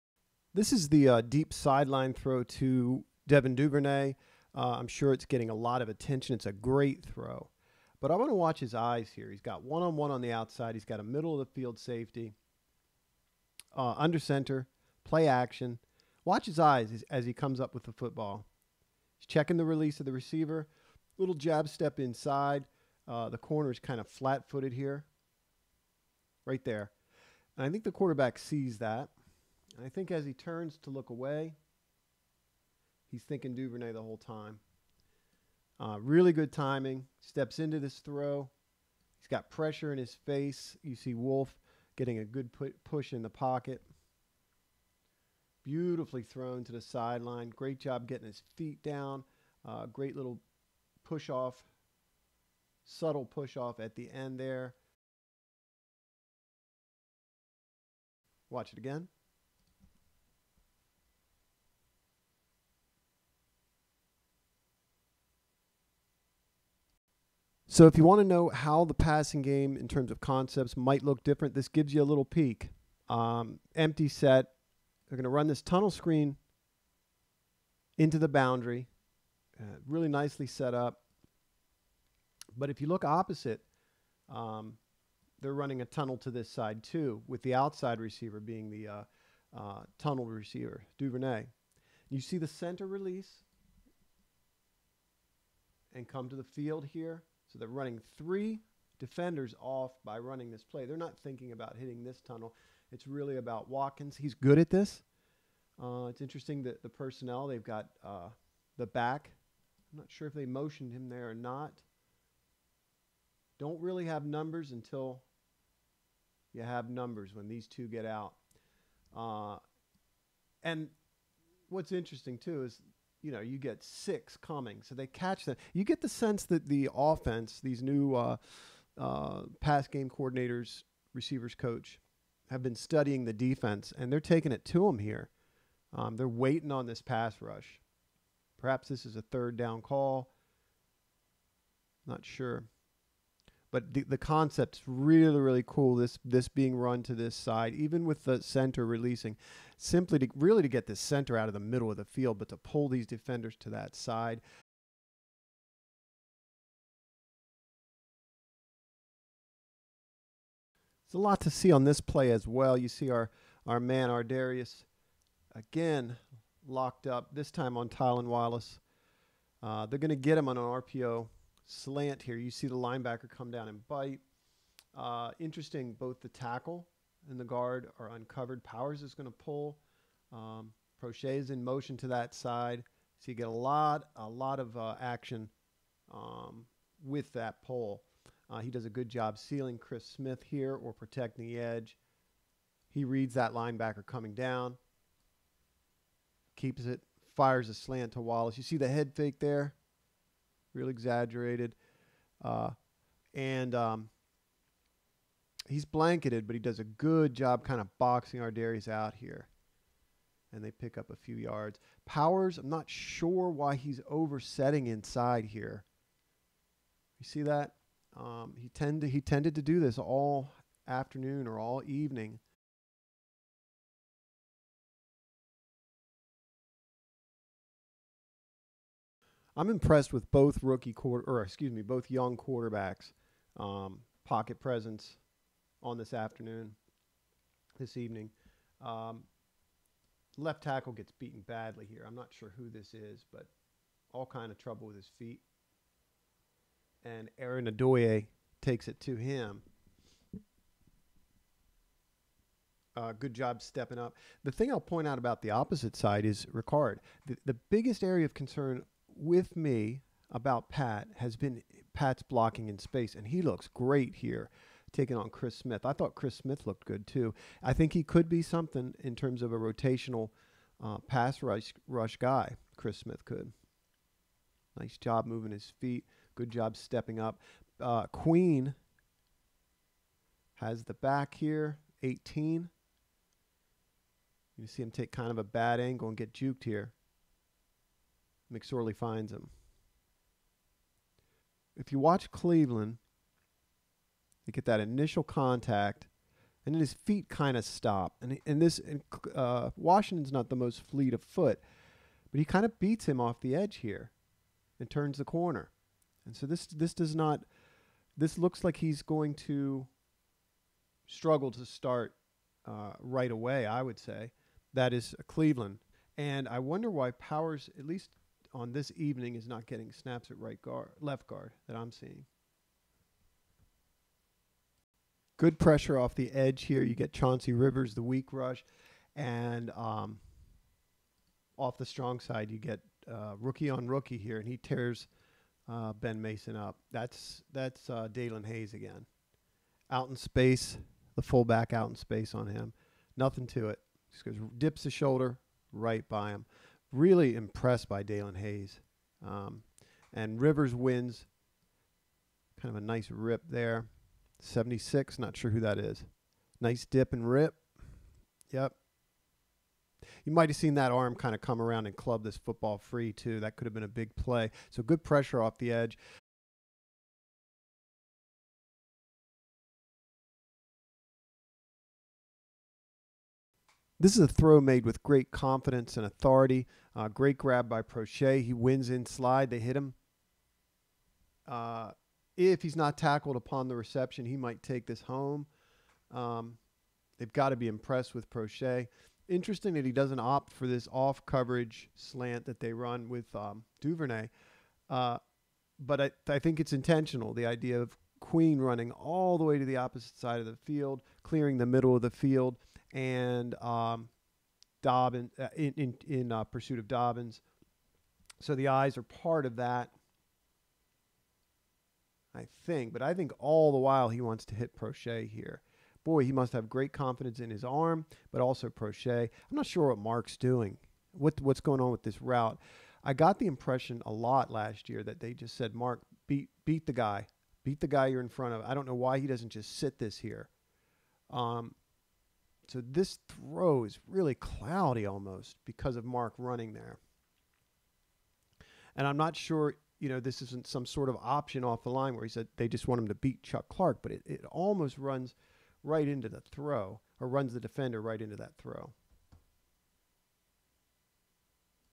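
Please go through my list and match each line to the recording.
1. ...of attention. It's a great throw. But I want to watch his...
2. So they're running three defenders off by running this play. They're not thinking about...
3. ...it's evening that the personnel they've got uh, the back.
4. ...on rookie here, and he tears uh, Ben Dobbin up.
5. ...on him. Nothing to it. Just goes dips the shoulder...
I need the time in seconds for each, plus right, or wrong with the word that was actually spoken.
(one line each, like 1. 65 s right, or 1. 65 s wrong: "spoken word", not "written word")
1. 5 s right
2. 97 s right
3. 106 s wrong: "interesting", not "evening"
4. 333 s wrong: "Mason", not "Dobbin"
5. 342 s right.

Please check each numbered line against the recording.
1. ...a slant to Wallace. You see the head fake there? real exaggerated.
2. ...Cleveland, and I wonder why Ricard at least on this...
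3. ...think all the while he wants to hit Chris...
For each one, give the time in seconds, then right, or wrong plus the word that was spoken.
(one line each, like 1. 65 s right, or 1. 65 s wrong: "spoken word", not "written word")
1. 197 s right
2. 315 s wrong: "Powers", not "Ricard"
3. 413 s wrong: "Proche", not "Chris".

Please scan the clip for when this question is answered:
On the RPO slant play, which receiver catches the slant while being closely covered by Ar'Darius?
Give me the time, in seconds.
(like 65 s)
167 s.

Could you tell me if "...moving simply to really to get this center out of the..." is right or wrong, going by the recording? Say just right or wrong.
wrong.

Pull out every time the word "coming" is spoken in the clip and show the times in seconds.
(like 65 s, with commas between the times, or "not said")
124 s, 194 s.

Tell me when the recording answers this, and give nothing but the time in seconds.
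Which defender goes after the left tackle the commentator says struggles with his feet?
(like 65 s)
247 s.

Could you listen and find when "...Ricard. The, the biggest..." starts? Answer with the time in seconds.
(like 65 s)
256 s.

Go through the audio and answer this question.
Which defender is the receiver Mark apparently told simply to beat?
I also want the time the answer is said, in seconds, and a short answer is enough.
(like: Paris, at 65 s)
Chuck Clark, at 443 s.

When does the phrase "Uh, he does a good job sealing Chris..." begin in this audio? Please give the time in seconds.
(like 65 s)
188 s.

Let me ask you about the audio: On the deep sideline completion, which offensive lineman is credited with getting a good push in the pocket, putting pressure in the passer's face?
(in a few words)
Wolfe.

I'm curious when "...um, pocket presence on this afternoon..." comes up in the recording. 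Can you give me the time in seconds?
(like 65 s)
233 s.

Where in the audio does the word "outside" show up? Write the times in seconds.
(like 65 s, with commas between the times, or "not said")
10 s, 87 s.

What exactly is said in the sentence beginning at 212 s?
Powers, I'm not sure why he's oversetting inside here.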